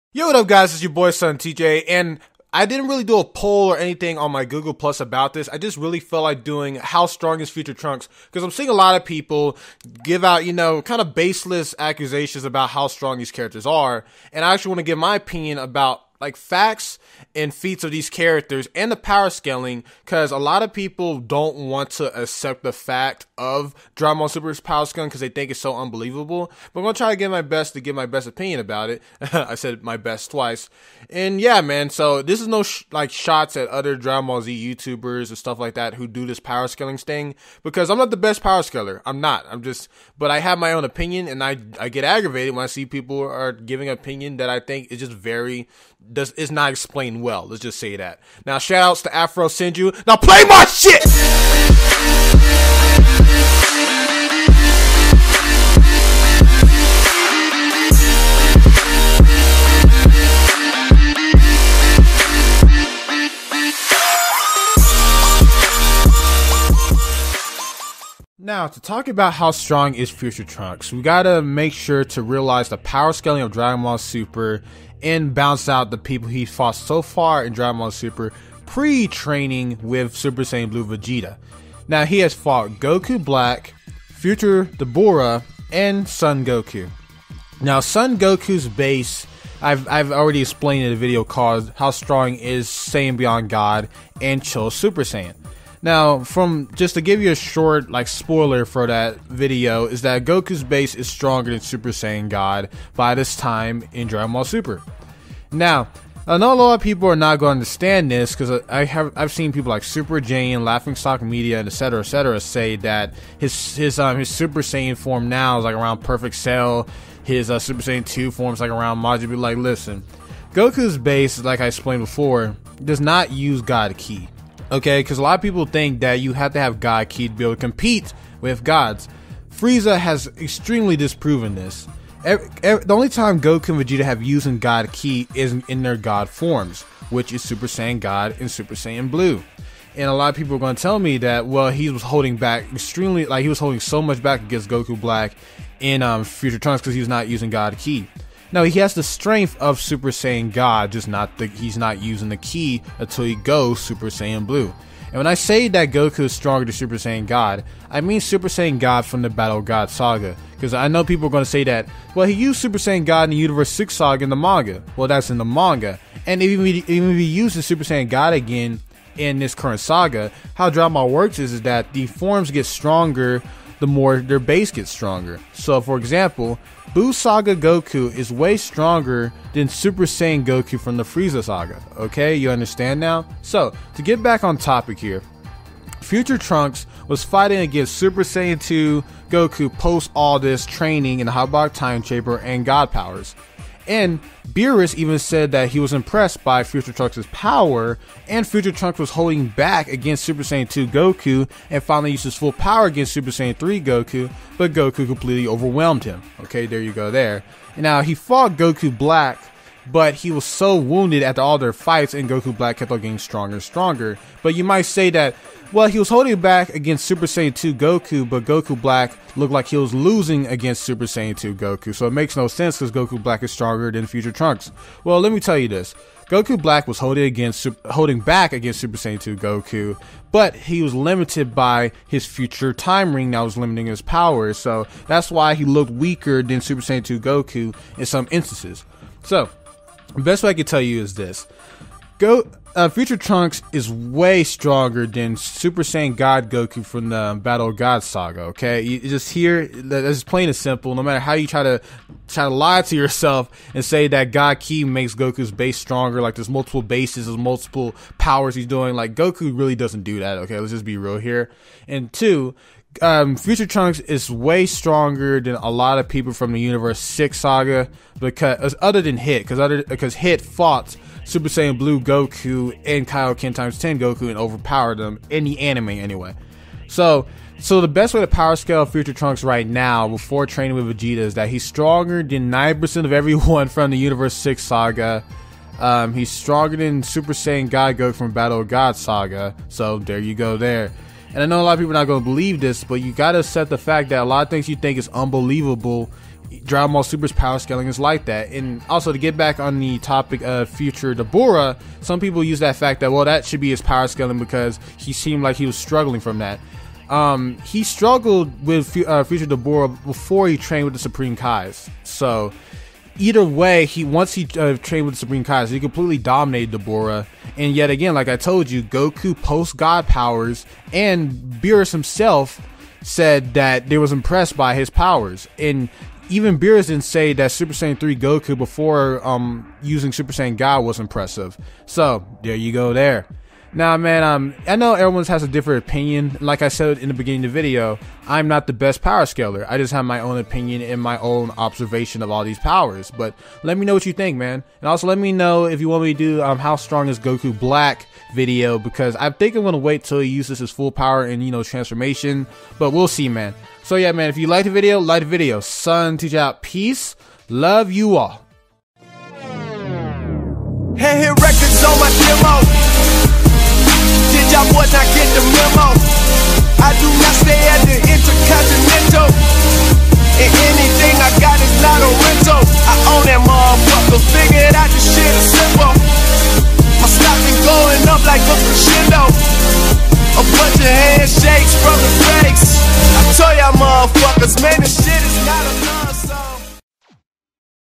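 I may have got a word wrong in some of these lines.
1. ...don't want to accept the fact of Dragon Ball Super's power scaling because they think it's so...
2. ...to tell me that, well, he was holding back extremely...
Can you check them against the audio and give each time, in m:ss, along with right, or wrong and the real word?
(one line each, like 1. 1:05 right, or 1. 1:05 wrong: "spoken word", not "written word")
1. 0:21 right
2. 2:20 right.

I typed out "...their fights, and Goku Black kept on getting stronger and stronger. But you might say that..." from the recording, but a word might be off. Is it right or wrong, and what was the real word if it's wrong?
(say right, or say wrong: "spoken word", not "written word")
right.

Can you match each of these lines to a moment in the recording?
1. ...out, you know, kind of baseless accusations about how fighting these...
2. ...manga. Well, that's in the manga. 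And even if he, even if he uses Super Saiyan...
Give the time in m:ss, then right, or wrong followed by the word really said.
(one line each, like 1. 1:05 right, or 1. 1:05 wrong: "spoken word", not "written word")
1. 0:10 wrong: "strong", not "fighting"
2. 2:44 right.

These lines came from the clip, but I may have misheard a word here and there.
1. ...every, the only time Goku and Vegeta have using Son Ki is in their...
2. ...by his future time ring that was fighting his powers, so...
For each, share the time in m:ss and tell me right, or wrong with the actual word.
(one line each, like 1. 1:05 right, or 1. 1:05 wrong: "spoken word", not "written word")
1. 2:12 wrong: "God", not "Son"
2. 3:51 wrong: "limiting", not "fighting".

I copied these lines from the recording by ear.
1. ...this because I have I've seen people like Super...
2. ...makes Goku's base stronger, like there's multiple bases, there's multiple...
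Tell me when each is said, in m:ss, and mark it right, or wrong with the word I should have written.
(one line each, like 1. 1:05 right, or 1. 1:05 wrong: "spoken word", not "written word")
1. 1:48 right
2. 4:14 right.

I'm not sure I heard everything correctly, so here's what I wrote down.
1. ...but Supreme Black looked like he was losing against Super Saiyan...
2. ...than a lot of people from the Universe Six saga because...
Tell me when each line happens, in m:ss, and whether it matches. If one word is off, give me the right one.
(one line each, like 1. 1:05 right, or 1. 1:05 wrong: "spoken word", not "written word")
1. 3:38 wrong: "Goku", not "Supreme"
2. 4:25 right.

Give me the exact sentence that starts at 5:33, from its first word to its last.
Now, man, um, I know everyone has a different opinion.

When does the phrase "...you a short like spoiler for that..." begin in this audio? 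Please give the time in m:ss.
1:37.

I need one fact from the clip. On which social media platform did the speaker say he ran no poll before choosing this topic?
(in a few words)
Google Plus.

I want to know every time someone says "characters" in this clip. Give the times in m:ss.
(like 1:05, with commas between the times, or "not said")
0:13, 0:18.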